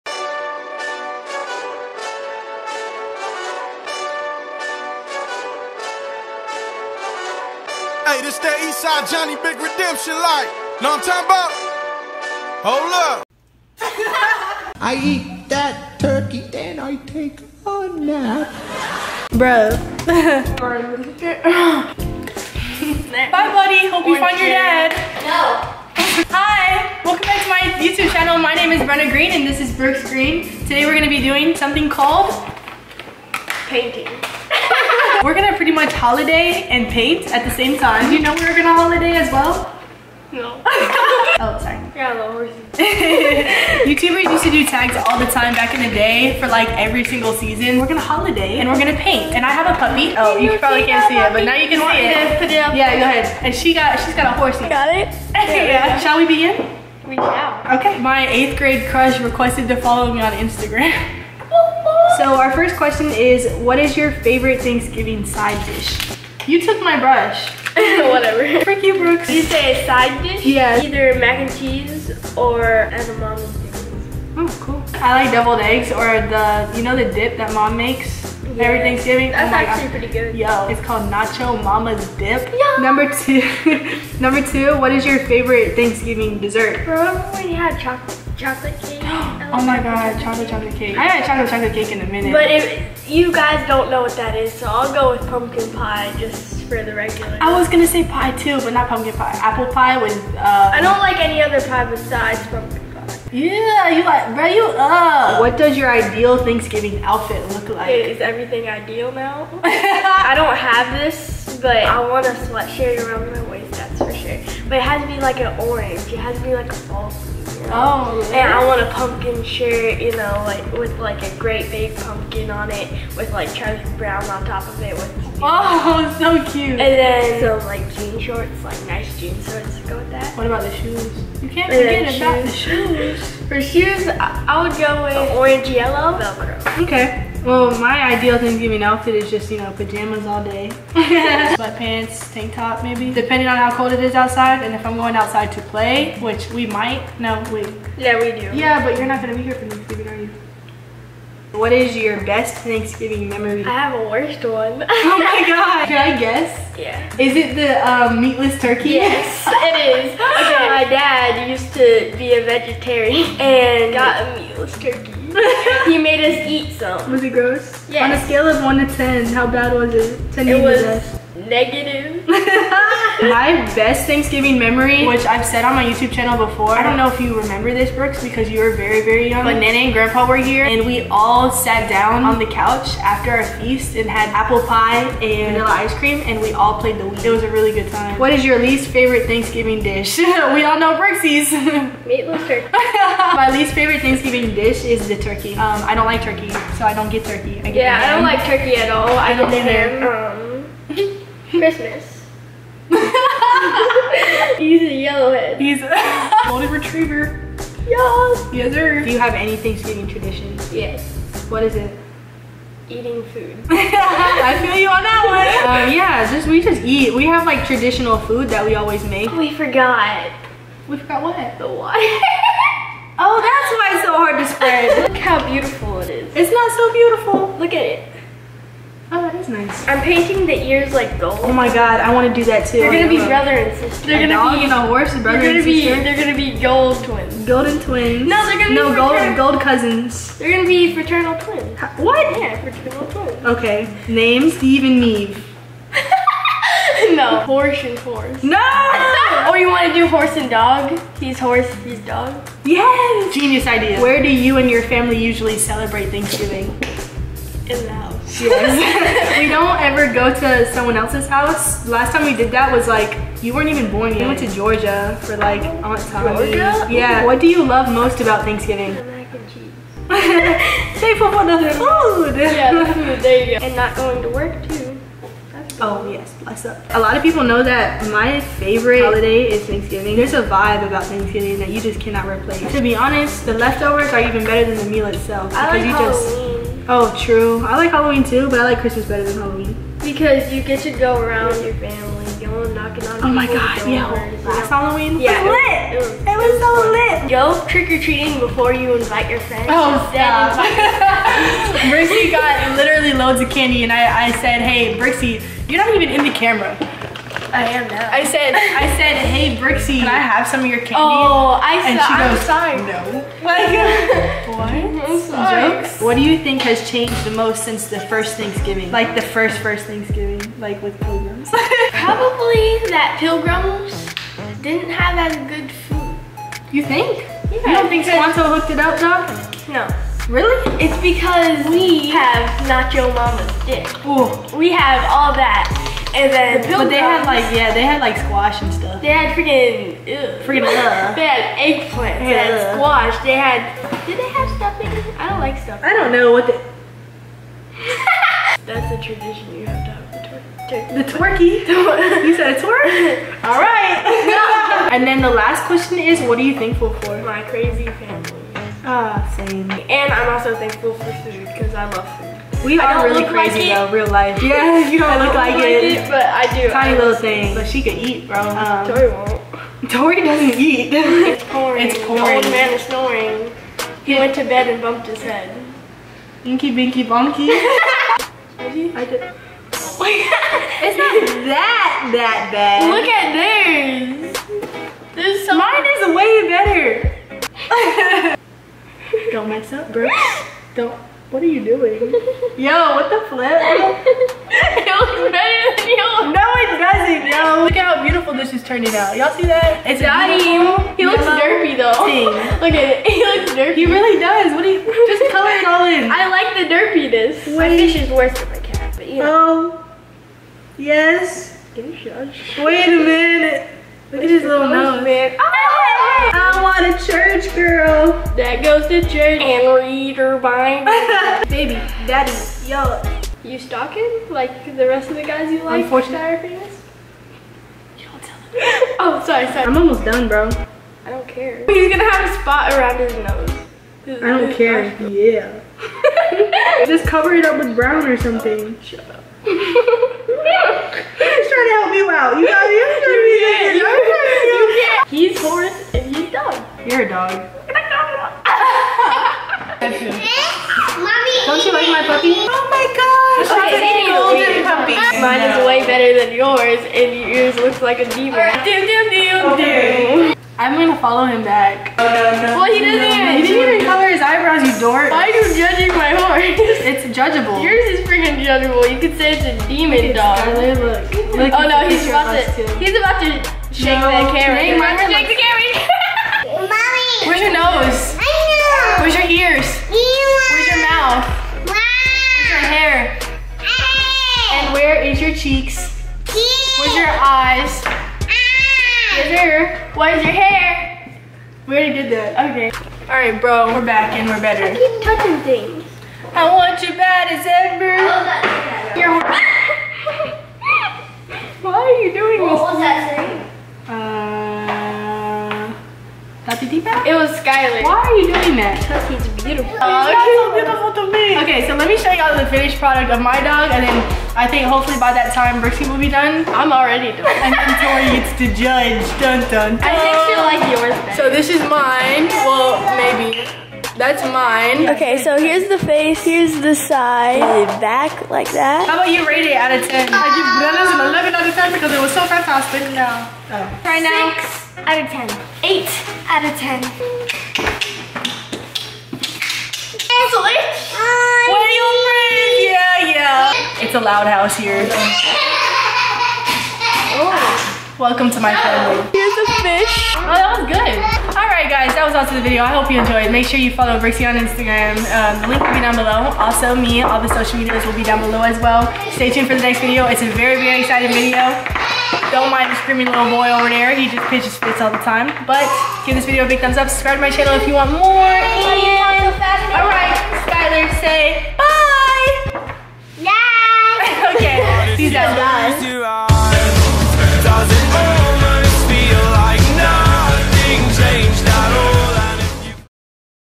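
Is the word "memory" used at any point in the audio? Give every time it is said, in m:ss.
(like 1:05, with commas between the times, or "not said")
2:33, 2:54.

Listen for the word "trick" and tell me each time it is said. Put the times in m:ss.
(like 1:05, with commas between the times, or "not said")
4:57.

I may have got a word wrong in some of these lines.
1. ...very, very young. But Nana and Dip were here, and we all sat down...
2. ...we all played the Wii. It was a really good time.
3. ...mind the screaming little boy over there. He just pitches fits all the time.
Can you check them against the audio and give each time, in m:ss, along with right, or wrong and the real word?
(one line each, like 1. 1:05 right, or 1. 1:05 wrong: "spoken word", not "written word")
1. 2:58 wrong: "Grandpa", not "Dip"
2. 3:06 right
3. 9:22 right.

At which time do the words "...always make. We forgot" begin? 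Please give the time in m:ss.
3:38.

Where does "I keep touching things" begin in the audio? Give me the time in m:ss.
8:14.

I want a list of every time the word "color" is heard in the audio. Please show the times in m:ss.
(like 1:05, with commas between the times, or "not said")
6:45, 7:43.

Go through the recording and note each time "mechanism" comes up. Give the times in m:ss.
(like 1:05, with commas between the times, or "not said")
not said.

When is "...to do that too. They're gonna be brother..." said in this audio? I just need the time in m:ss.
3:52.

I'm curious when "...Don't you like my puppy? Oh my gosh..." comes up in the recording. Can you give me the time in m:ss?
7:31.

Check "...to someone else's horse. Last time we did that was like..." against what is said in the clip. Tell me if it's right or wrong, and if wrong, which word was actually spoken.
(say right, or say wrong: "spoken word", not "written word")
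wrong: "house", not "horse".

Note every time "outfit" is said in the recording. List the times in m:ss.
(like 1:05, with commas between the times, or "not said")
1:47, 2:18.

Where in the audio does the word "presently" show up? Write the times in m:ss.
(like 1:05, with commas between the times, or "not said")
not said.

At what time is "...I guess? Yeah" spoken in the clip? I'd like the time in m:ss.
2:36.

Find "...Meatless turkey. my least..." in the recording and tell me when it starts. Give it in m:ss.
3:12.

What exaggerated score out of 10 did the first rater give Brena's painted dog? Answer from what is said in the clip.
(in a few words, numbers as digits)
11.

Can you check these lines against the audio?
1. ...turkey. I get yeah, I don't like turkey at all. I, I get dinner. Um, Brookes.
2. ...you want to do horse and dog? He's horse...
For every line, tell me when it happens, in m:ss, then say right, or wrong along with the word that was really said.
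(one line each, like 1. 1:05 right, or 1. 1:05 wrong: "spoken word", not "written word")
1. 3:17 wrong: "Christmas", not "Brookes"
2. 4:09 right.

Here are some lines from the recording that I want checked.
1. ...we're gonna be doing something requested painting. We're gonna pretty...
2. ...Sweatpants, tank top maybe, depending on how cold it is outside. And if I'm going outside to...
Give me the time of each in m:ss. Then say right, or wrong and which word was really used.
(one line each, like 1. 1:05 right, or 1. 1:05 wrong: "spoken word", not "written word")
1. 0:30 wrong: "called", not "requested"
2. 2:20 right.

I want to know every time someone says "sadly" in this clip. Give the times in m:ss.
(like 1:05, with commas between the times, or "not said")
not said.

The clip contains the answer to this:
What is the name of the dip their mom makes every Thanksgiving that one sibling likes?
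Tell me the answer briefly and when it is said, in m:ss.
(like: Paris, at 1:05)
Nacho Mama's Dip, at 1:21.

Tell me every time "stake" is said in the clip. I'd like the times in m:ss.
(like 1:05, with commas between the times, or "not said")
not said.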